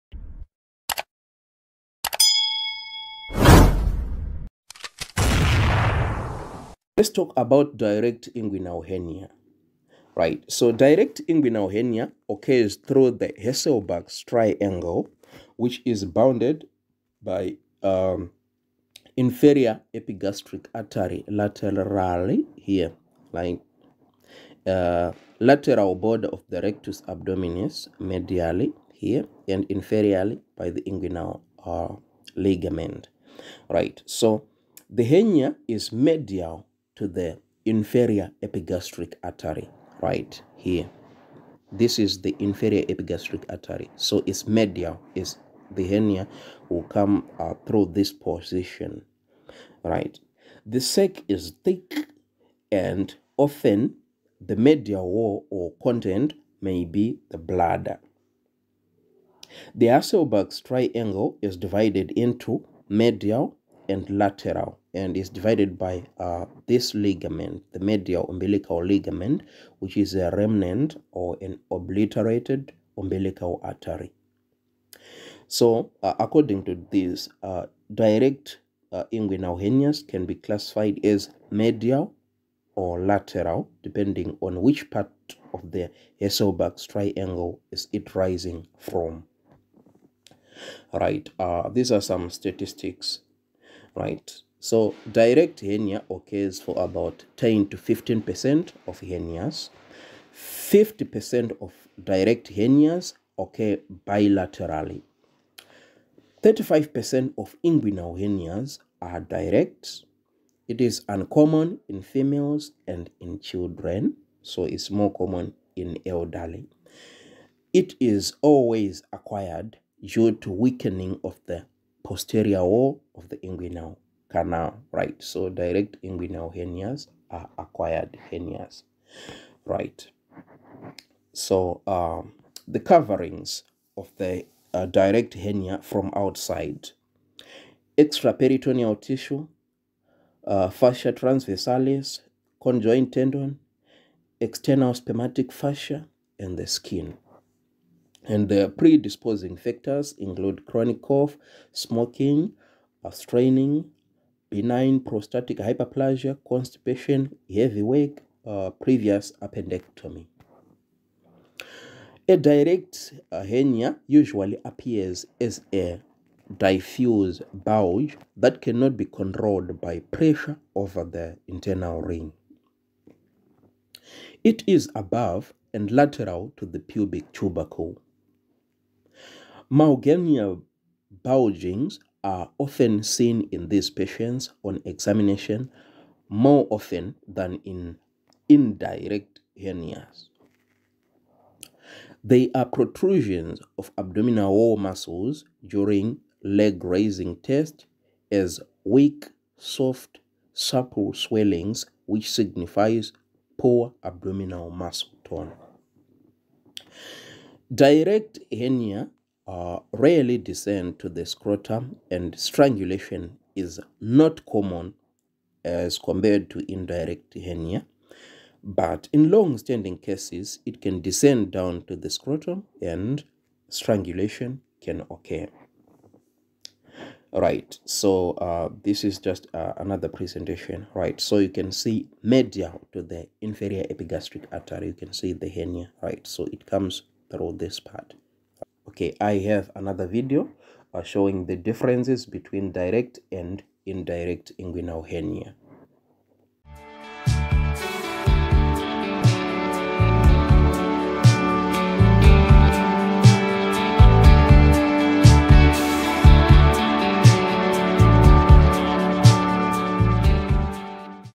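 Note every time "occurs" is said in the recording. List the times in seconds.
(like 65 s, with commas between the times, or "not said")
12 s, 96 s, 103 s, 225 s.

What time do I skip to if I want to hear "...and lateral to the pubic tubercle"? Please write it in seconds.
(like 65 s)
175 s.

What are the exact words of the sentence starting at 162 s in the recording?
A direct uh, hernia usually appears as a diffuse bulge that cannot be controlled by pressure over the internal ring.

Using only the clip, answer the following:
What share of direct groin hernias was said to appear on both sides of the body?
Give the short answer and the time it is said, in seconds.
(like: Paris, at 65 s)
50%, at 100 s.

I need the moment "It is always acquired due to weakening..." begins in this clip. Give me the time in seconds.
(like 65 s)
117 s.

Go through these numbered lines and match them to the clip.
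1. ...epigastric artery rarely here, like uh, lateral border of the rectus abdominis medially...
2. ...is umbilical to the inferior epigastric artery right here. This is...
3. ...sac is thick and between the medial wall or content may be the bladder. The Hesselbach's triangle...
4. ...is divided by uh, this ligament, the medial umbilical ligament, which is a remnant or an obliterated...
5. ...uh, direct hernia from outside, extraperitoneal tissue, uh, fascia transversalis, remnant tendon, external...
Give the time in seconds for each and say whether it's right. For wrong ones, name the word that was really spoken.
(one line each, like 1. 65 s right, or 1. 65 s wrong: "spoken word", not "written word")
1. 19 s wrong: "laterally", not "rarely"
2. 35 s wrong: "medial", not "umbilical"
3. 50 s wrong: "often", not "between"
4. 65 s right
5. 134 s wrong: "conjoint", not "remnant".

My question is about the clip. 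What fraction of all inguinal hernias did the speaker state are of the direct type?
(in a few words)
35%.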